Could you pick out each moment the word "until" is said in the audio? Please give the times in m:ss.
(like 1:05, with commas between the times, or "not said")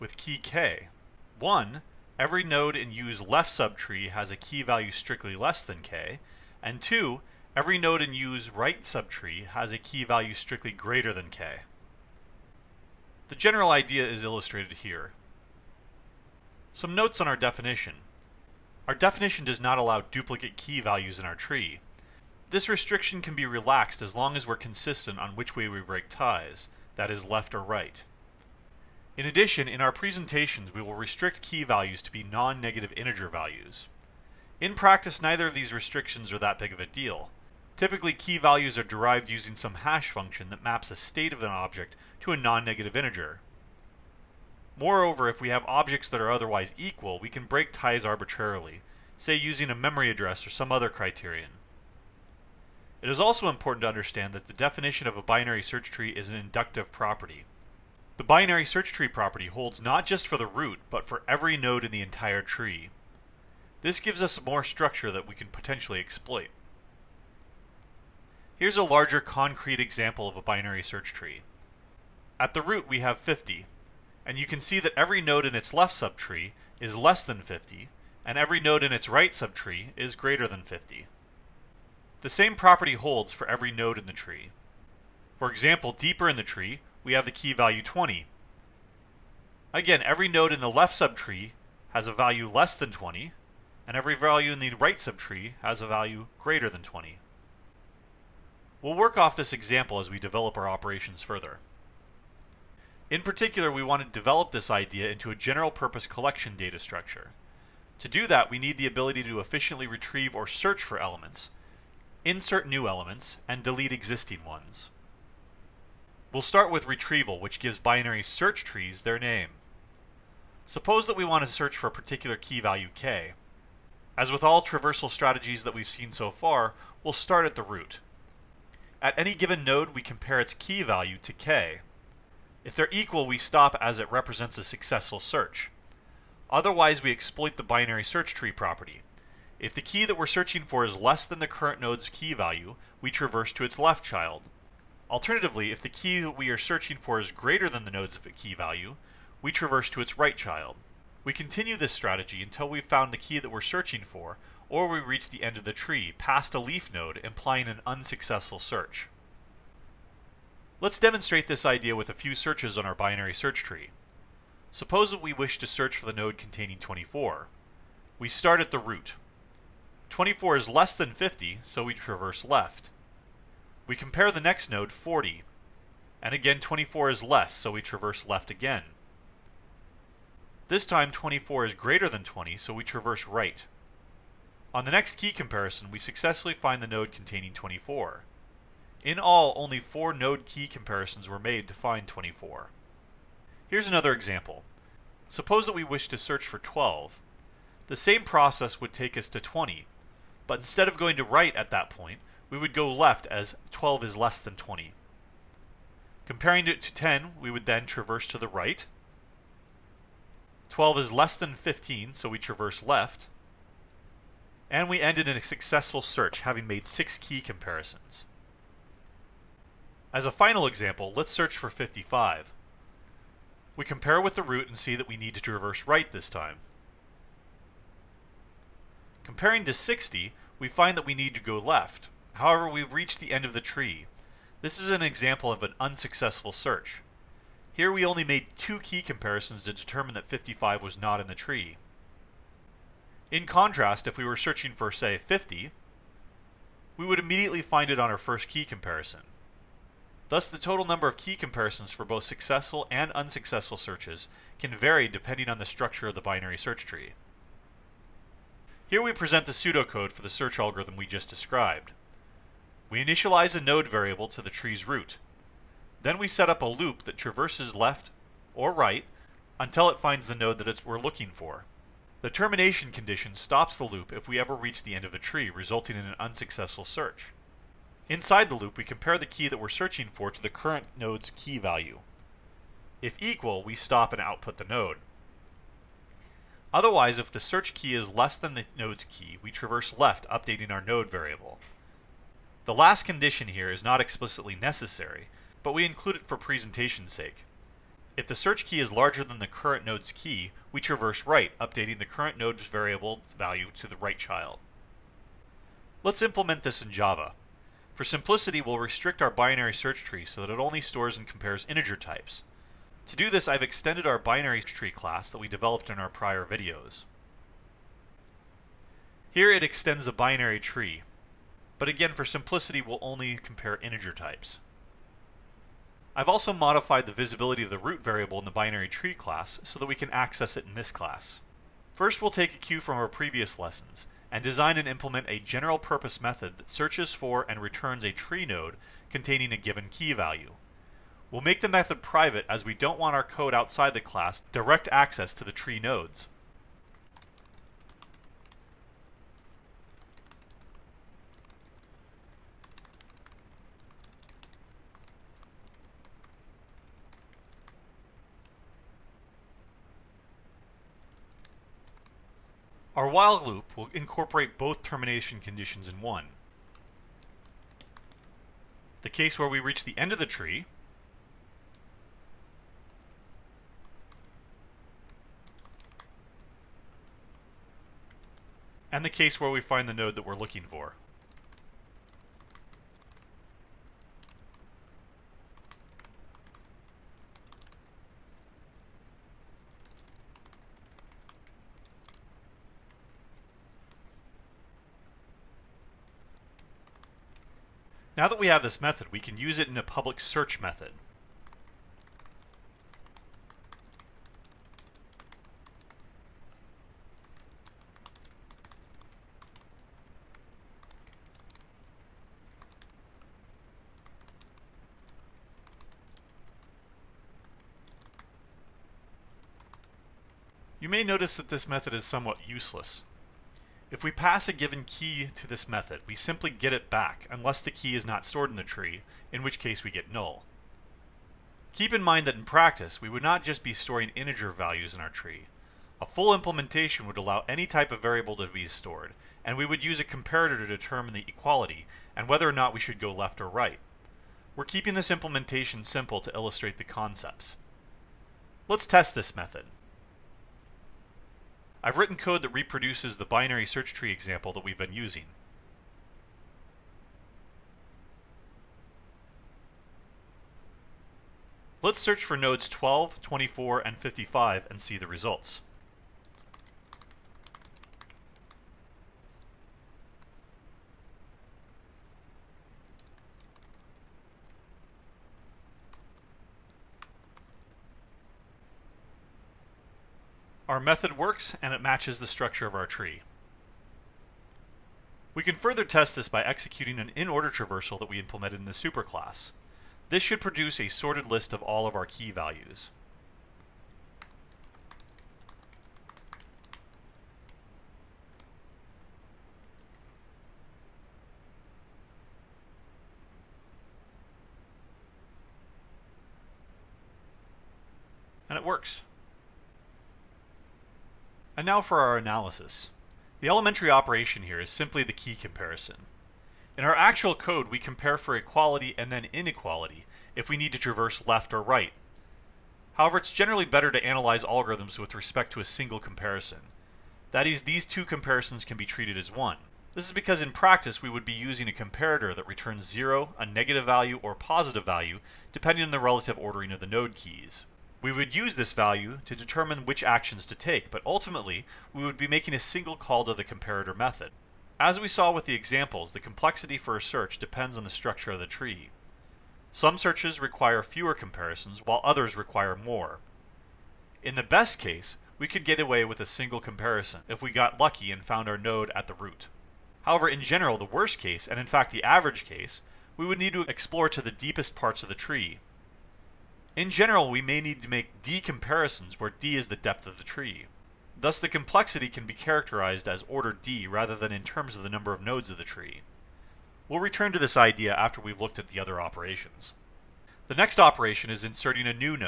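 2:32, 4:29.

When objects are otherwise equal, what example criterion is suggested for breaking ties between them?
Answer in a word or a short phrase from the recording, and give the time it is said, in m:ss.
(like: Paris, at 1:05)
memory address, at 0:49.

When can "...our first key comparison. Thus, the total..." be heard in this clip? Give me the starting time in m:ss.
4:08.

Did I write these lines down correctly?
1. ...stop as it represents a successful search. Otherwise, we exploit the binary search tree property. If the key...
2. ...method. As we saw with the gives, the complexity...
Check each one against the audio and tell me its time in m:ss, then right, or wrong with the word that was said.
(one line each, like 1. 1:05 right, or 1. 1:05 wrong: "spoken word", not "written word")
1. 2:13 right
2. 9:03 wrong: "examples", not "gives".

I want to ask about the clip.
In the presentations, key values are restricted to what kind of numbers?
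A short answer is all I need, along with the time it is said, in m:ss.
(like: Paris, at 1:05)
non-negative integer values, at 0:32.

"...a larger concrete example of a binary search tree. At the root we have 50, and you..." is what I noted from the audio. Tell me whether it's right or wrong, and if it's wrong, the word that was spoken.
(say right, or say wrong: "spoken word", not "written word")
right.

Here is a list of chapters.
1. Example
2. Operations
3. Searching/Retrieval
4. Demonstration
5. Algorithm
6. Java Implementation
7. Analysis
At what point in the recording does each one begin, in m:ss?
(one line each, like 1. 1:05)
1. 1:07
2. 1:42
3. 1:55
4. 2:39
5. 4:18
6. 5:05
7. 8:31.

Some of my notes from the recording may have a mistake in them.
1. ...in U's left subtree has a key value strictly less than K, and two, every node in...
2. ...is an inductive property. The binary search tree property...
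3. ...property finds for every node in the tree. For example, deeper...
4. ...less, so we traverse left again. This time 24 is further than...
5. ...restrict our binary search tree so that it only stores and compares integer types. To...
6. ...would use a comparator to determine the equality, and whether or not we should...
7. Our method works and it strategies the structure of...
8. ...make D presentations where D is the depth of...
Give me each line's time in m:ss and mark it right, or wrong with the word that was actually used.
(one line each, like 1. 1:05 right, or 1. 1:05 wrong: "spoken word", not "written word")
1. 0:02 right
2. 0:56 right
3. 1:22 wrong: "holds", not "finds"
4. 2:57 wrong: "greater", not "further"
5. 5:08 right
6. 7:19 right
7. 8:00 wrong: "matches", not "strategies"
8. 9:27 wrong: "comparisons", not "presentations".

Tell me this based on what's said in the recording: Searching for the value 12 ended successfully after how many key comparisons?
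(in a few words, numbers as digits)
6.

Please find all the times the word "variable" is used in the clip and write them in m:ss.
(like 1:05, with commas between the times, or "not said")
4:23, 4:51, 5:02, 5:28, 7:18.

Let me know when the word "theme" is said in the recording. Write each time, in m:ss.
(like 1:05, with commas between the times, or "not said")
not said.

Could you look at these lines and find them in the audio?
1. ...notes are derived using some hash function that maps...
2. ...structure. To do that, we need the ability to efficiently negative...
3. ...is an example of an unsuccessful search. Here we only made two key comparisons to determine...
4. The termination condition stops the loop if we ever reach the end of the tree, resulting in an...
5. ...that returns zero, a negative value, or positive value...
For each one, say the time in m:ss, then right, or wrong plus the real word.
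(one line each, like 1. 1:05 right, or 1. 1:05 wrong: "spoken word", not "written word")
1. 0:38 wrong: "values", not "notes"
2. 1:46 wrong: "retrieve", not "negative"
3. 3:54 right
4. 4:32 right
5. 8:52 right.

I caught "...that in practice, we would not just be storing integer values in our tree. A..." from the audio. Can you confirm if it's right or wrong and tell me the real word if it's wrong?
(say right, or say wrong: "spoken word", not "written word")
right.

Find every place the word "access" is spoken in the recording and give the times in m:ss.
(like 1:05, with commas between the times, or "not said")
5:30, 5:44.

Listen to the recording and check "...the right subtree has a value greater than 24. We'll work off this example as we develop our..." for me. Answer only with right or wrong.
wrong.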